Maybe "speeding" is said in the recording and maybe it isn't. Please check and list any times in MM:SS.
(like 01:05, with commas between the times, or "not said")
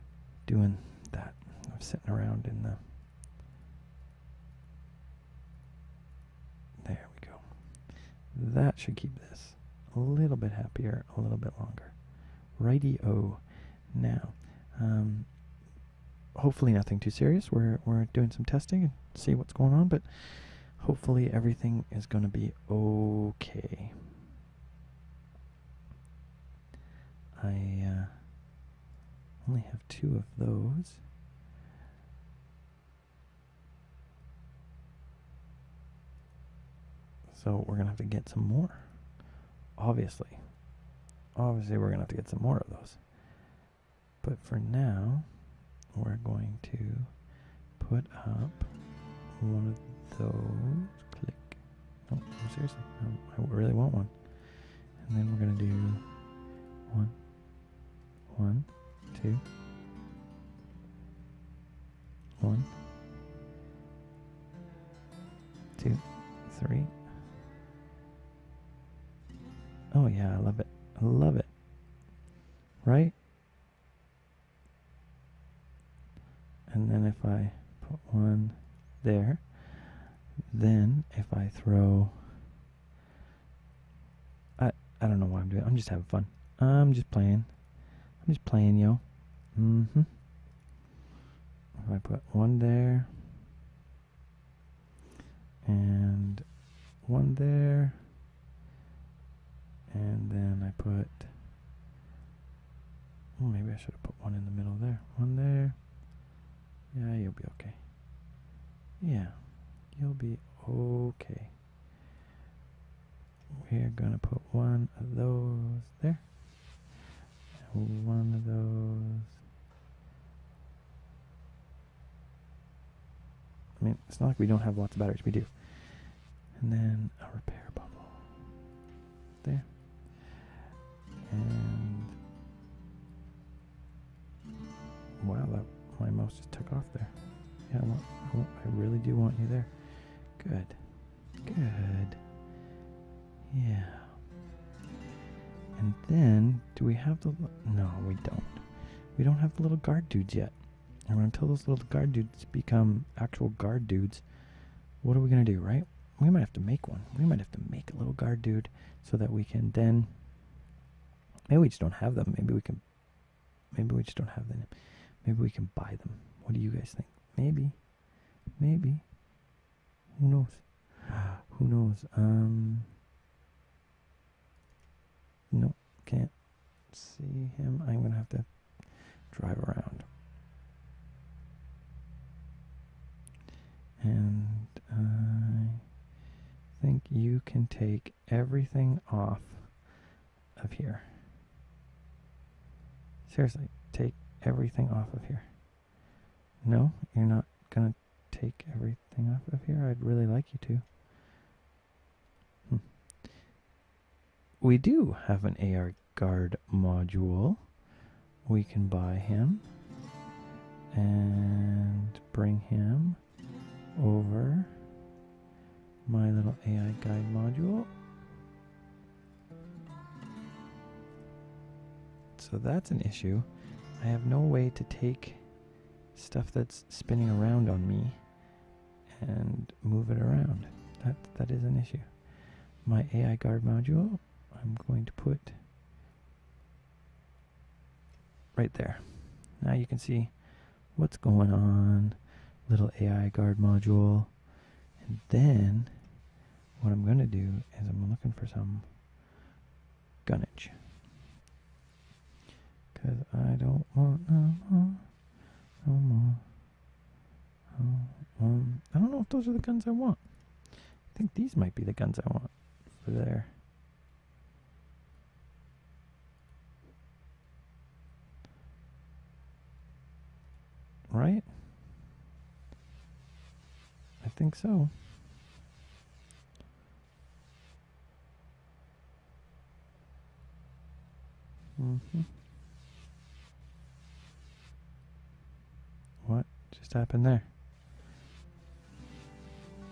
not said.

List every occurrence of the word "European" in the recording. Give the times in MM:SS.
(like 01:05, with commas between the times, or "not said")
not said.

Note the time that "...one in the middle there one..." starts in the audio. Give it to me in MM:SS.
01:44.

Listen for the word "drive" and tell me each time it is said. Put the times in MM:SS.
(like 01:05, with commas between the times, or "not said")
02:59.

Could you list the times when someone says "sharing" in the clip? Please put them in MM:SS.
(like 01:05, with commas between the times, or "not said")
not said.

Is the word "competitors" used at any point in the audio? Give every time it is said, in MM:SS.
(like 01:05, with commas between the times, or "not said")
not said.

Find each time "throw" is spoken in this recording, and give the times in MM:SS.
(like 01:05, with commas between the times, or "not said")
01:21.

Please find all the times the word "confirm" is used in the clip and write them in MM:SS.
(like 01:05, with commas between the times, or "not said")
not said.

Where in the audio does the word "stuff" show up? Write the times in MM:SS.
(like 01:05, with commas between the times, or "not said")
03:46.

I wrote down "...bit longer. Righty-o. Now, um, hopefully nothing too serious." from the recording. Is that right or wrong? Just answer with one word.
right.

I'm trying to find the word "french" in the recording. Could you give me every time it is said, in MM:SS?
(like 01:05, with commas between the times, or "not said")
not said.